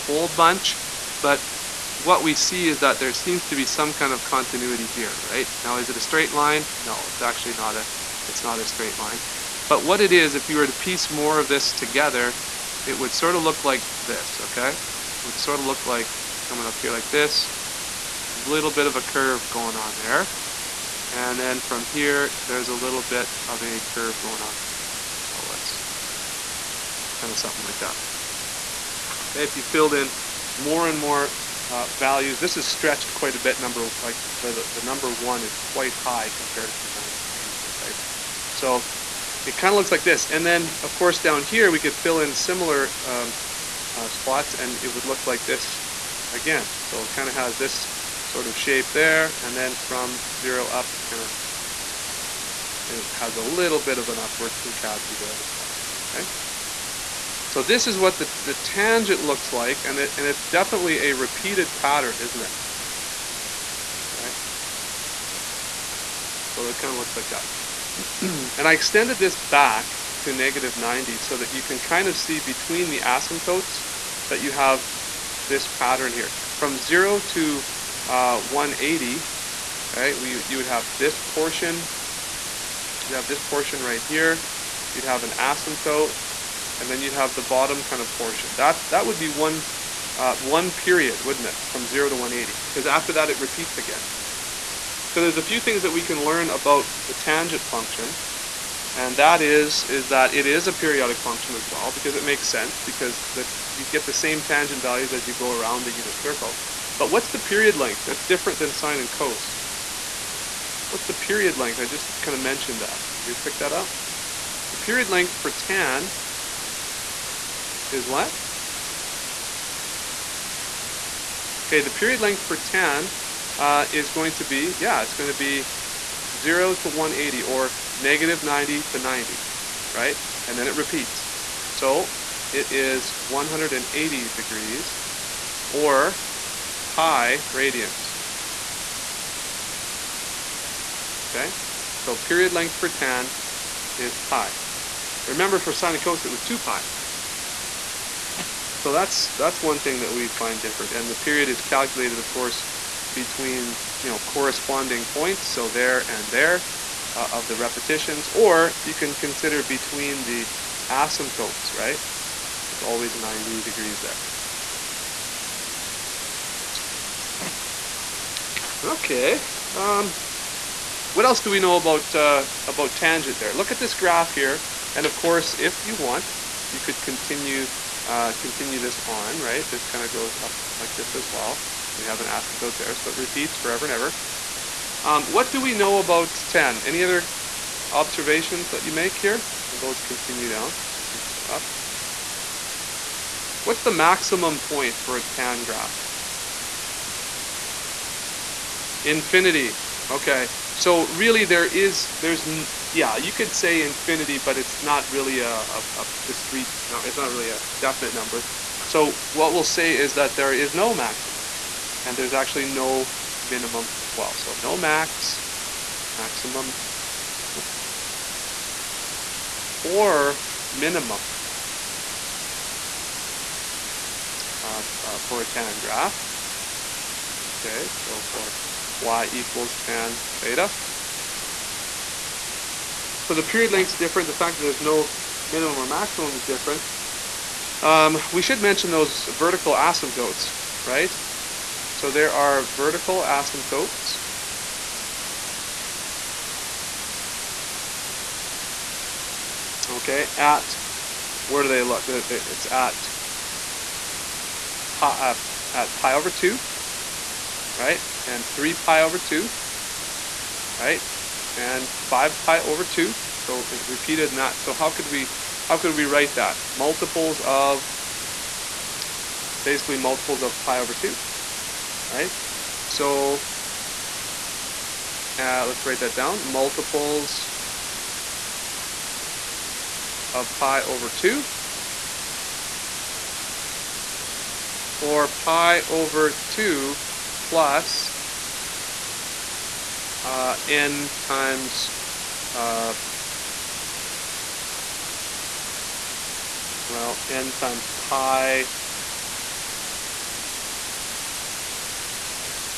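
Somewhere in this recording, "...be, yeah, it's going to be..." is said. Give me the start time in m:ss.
2:04.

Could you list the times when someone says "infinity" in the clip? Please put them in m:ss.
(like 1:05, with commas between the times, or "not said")
3:19, 3:23.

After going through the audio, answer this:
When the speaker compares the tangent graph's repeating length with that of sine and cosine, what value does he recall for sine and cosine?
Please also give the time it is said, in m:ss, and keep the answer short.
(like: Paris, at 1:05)
2 pi, at 2:26.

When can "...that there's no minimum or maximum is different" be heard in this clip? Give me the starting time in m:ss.
3:54.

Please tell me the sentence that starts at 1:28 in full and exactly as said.
That's, that would be one, uh, one period, wouldn't it, from 0 to 180, because after that it repeats again.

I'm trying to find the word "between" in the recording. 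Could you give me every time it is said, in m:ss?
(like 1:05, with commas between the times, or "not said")
1:12, 2:33, 2:39.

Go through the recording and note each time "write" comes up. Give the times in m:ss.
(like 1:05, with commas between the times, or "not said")
4:26, 4:35.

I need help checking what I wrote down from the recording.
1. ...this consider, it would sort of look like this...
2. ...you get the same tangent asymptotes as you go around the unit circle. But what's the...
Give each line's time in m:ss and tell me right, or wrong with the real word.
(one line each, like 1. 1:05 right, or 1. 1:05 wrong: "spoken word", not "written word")
1. 0:11 wrong: "together", not "consider"
2. 1:43 wrong: "values", not "asymptotes".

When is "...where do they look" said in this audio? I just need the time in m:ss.
4:11.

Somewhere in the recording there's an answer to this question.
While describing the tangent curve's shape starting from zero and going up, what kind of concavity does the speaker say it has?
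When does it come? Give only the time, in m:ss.
0:54.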